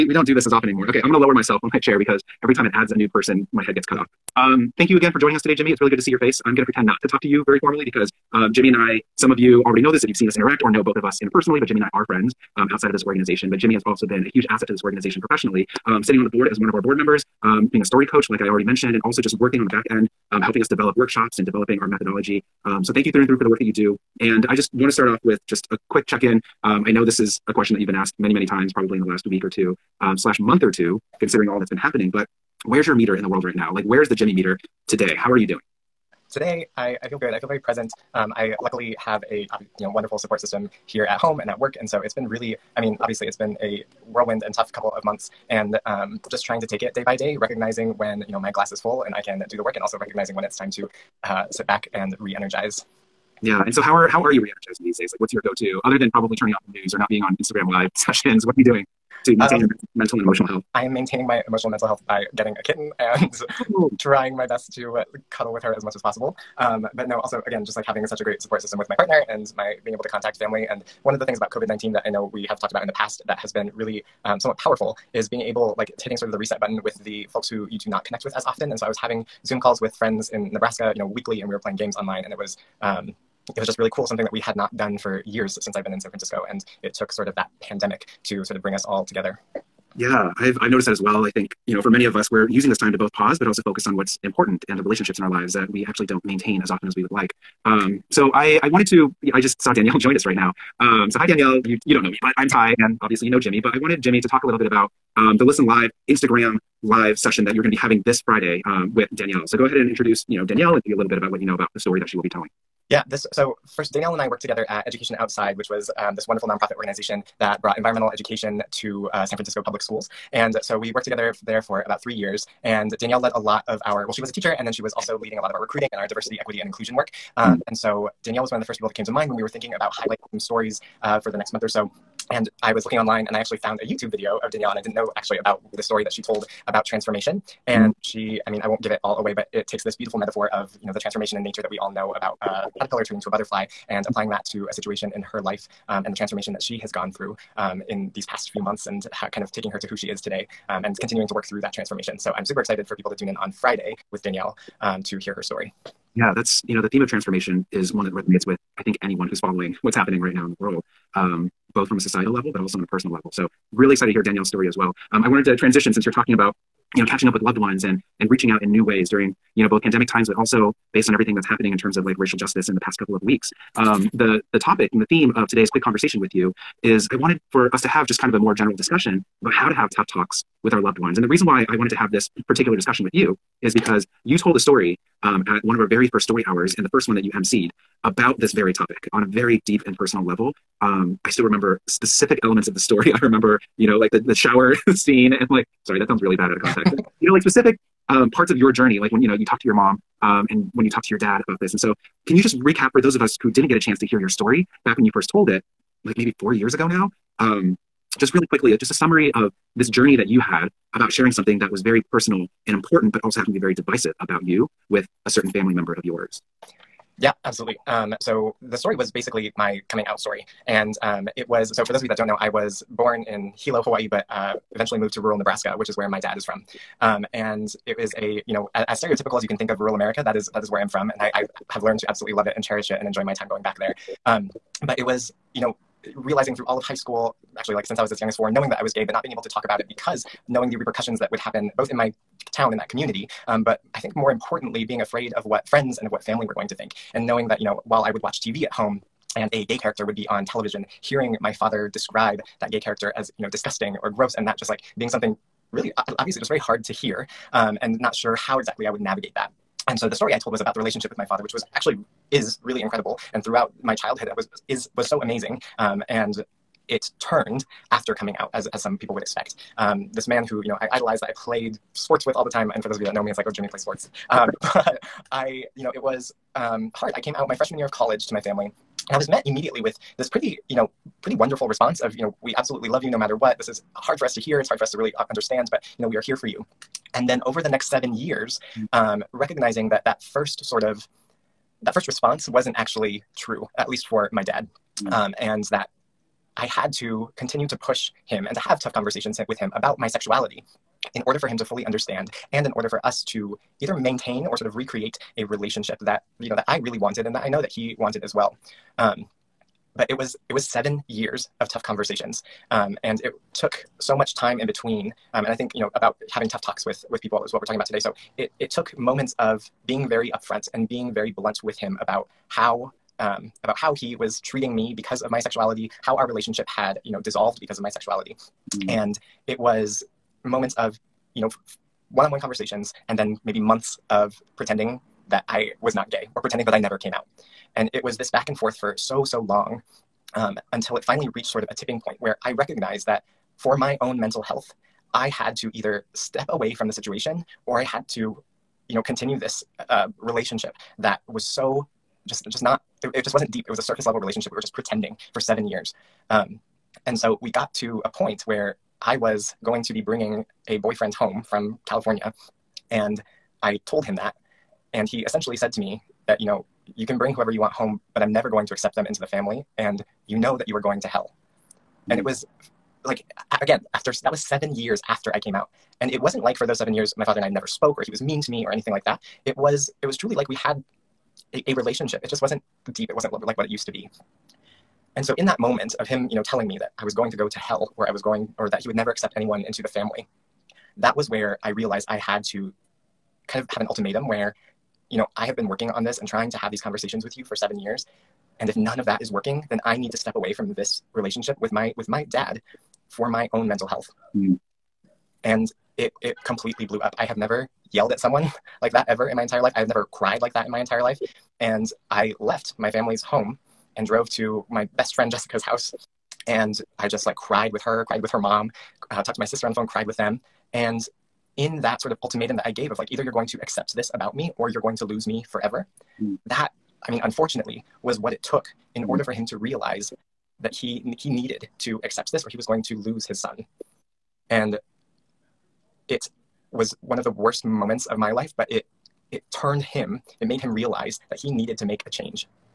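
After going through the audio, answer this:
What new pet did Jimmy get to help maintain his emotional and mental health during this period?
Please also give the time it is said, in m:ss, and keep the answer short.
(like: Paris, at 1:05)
A kitten, at 1:02.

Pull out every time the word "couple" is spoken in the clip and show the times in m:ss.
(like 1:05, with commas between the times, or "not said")
0:44, 2:52.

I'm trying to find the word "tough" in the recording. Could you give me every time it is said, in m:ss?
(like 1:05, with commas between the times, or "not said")
0:44, 2:59, 4:58, 5:11, 5:16.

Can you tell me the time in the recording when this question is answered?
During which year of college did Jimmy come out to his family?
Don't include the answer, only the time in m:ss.
4:37.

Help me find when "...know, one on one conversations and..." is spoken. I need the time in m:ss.
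5:31.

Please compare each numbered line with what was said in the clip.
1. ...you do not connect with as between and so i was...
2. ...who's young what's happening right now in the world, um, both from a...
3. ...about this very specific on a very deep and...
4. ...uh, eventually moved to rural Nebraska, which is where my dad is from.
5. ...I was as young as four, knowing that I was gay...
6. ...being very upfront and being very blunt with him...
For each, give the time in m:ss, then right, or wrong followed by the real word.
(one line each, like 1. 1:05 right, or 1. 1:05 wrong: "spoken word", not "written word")
1. 1:17 wrong: "often", not "between"
2. 2:39 wrong: "following", not "young"
3. 3:08 wrong: "topic", not "specific"
4. 3:44 right
5. 3:57 right
6. 5:19 right.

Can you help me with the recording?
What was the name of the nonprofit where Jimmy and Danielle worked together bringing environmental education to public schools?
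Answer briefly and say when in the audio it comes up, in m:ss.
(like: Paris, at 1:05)
Education Outside, at 1:54.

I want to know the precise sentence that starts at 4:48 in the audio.
um, recognizing that that first sort of that first response wasn't actually true, at least for my dad.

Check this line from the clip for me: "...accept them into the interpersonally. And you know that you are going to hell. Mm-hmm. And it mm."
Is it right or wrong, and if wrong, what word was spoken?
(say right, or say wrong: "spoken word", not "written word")
wrong: "family", not "interpersonally".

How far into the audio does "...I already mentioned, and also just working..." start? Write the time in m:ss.
0:18.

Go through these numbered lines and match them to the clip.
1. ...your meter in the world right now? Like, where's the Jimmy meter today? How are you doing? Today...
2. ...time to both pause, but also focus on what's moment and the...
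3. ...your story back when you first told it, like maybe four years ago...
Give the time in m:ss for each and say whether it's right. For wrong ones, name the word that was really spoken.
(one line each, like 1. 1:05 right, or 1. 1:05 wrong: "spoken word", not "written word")
1. 0:32 right
2. 1:32 wrong: "important", not "moment"
3. 3:24 right.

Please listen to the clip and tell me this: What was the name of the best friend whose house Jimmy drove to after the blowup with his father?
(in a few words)
Jessica.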